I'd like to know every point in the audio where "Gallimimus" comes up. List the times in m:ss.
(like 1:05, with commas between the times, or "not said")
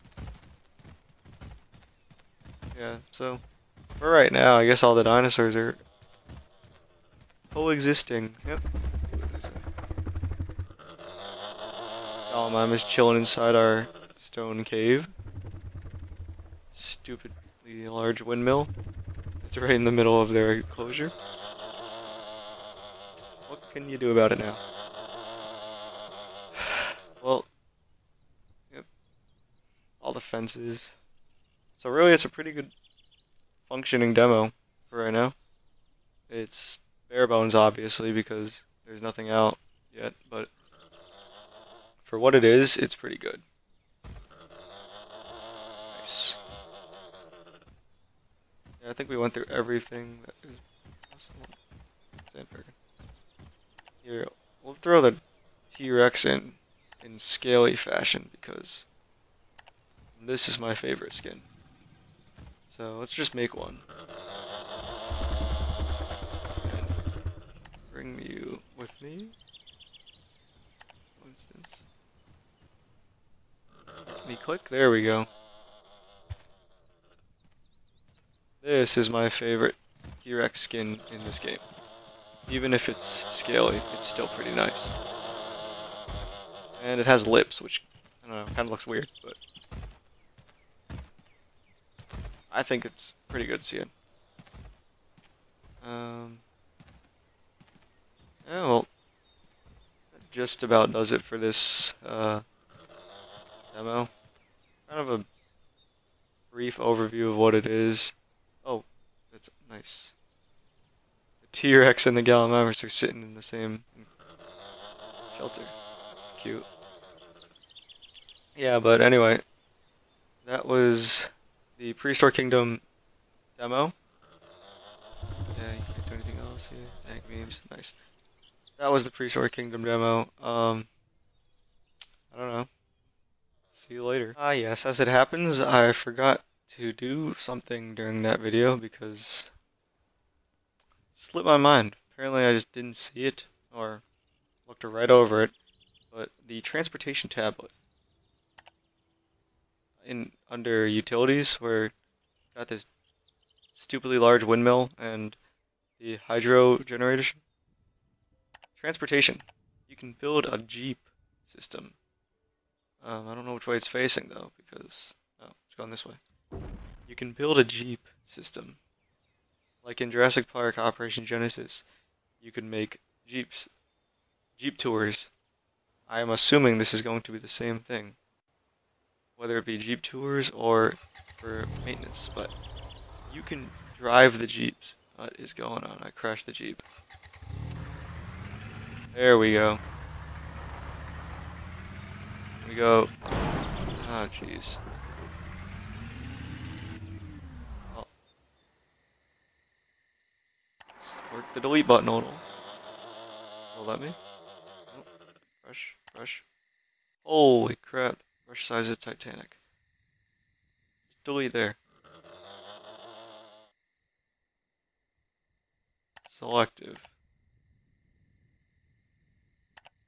0:12, 1:52.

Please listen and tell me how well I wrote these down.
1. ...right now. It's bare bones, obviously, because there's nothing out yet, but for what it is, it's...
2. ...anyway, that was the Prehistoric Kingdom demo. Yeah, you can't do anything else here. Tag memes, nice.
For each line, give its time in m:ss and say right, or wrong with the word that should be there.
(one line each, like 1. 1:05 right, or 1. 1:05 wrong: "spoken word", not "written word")
1. 0:35 right
2. 1:59 right.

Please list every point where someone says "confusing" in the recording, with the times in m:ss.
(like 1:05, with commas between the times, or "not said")
not said.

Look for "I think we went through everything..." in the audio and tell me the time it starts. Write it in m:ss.
0:48.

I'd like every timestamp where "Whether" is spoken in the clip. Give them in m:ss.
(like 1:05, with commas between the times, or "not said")
2:59.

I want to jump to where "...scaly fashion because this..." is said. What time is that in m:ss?
0:57.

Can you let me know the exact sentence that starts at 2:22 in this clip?
Apparently I just didn't see it or looked right over it.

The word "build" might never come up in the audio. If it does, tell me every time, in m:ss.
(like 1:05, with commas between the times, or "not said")
2:40, 2:47.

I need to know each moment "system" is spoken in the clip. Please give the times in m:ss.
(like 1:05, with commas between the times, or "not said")
2:41, 2:48.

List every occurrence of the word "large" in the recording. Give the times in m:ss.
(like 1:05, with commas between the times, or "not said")
0:17, 2:34.